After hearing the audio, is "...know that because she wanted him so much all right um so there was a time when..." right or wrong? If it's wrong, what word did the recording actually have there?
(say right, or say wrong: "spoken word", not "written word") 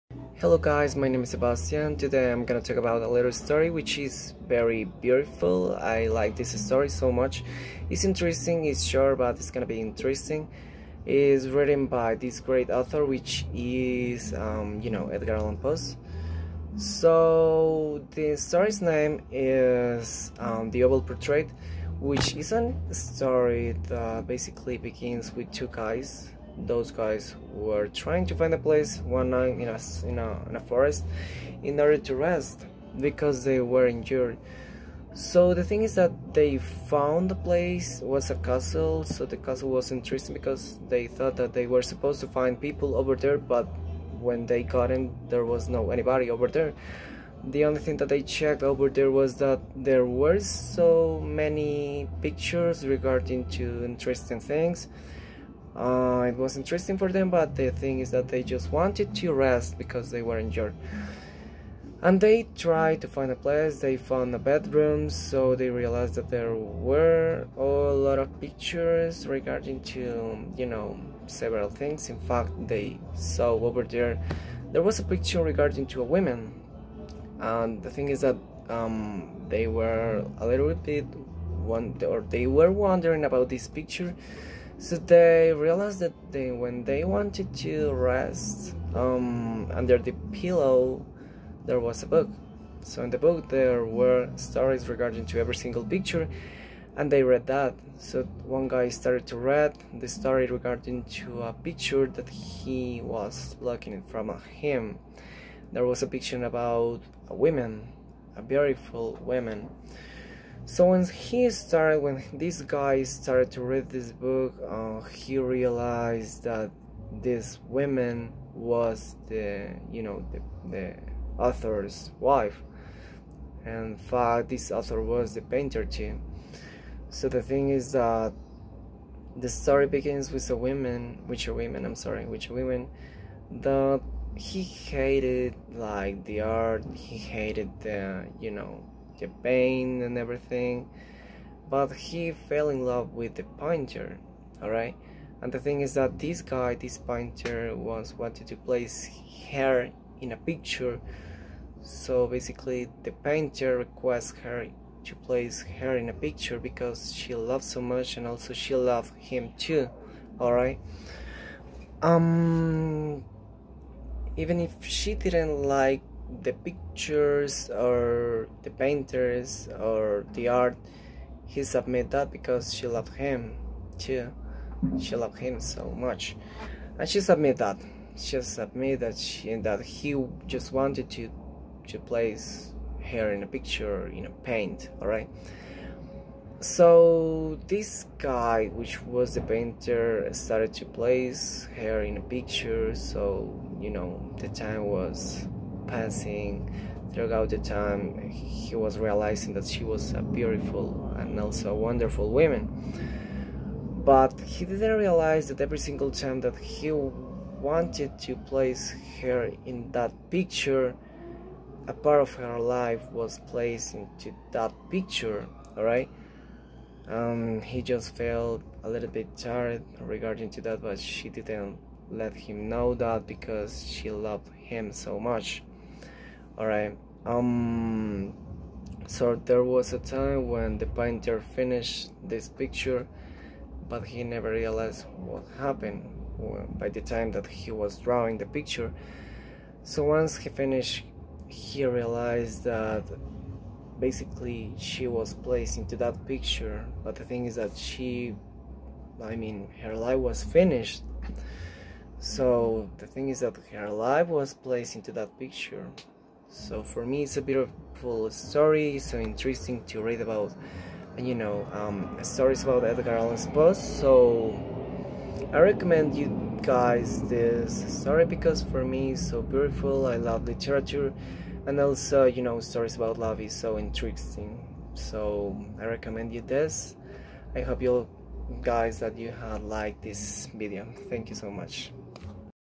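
wrong: "loved", not "wanted".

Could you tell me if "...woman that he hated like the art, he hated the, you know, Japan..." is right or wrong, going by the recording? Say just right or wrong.
right.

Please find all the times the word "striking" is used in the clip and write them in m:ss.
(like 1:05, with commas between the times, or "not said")
not said.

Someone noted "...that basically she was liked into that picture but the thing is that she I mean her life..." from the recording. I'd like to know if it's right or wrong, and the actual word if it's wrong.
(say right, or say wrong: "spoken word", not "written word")
wrong: "placed", not "liked".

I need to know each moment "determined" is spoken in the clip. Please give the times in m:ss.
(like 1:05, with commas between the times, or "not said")
not said.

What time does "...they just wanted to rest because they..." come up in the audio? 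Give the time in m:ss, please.
0:58.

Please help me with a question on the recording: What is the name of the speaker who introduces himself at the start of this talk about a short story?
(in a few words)
Sebastian.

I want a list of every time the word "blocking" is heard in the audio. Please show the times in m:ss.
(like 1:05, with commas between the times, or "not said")
1:43.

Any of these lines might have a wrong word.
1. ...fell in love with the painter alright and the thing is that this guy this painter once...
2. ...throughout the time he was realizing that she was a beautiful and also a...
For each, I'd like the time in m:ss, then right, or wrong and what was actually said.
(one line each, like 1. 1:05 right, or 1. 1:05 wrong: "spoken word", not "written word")
1. 2:22 right
2. 3:17 right.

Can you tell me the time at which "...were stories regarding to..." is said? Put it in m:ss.
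1:33.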